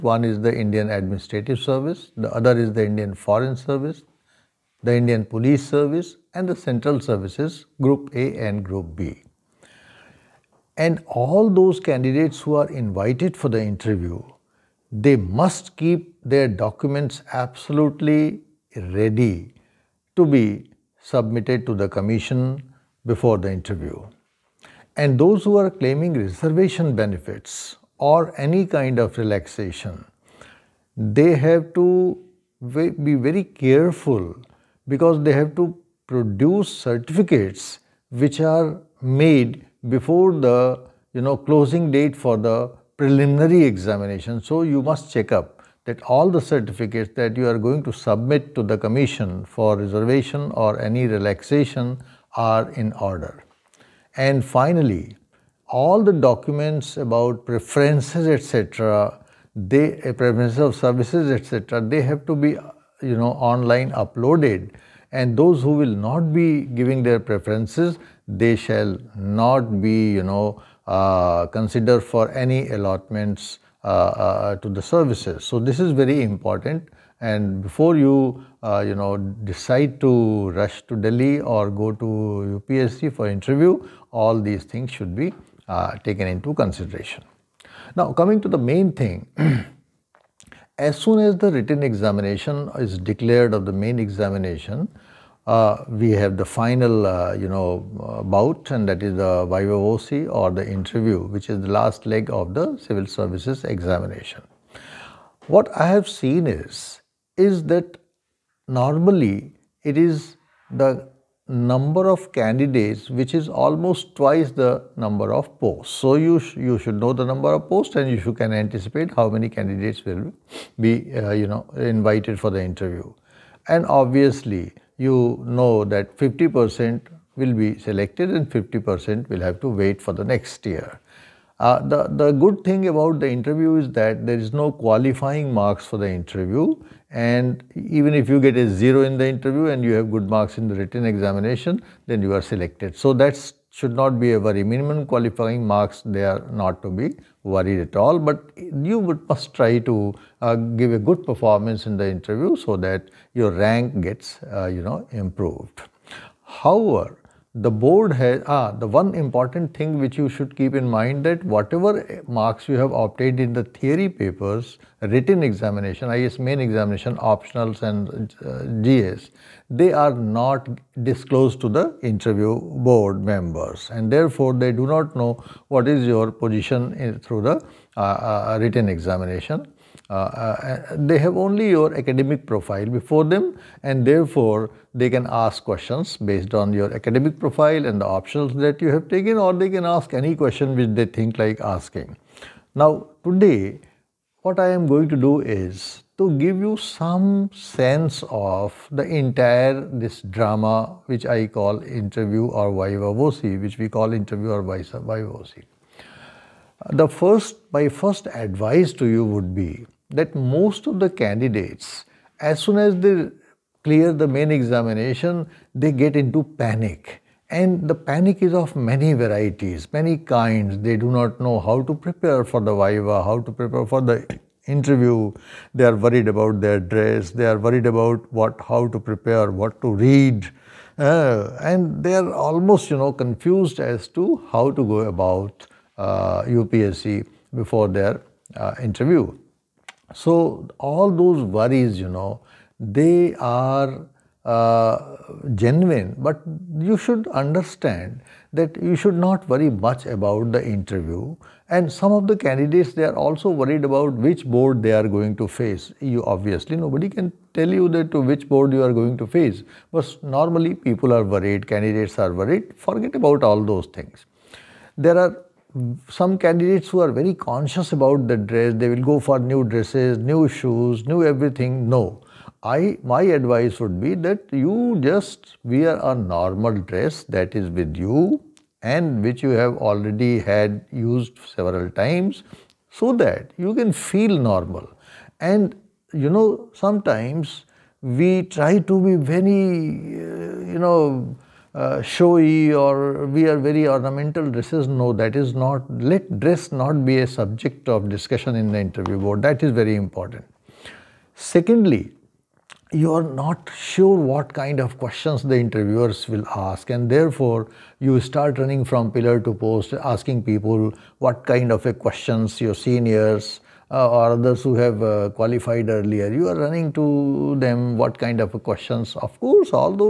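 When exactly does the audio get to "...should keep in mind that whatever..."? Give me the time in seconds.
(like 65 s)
160 s.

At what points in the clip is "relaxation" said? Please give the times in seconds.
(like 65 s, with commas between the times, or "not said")
29 s, 51 s.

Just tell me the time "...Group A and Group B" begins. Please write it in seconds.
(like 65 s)
7 s.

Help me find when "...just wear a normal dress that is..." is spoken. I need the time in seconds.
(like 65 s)
274 s.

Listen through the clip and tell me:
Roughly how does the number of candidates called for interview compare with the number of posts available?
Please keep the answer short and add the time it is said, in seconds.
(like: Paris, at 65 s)
twice, at 114 s.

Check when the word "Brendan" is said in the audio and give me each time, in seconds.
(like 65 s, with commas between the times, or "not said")
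not said.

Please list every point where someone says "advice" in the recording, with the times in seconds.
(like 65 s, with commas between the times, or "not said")
208 s, 273 s.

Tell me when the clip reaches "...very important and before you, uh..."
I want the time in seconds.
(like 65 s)
75 s.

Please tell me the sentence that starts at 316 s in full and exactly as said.
You are running to them what kind of questions.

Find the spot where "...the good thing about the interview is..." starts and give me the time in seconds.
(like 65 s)
132 s.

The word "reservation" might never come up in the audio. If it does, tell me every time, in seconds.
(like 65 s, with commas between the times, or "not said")
26 s, 49 s.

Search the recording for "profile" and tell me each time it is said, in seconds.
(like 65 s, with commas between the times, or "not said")
182 s, 187 s.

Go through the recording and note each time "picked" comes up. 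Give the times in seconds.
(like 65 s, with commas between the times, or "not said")
not said.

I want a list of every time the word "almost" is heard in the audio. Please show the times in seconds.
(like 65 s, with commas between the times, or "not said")
113 s, 232 s.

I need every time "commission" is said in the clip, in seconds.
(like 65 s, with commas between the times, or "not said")
21 s, 48 s.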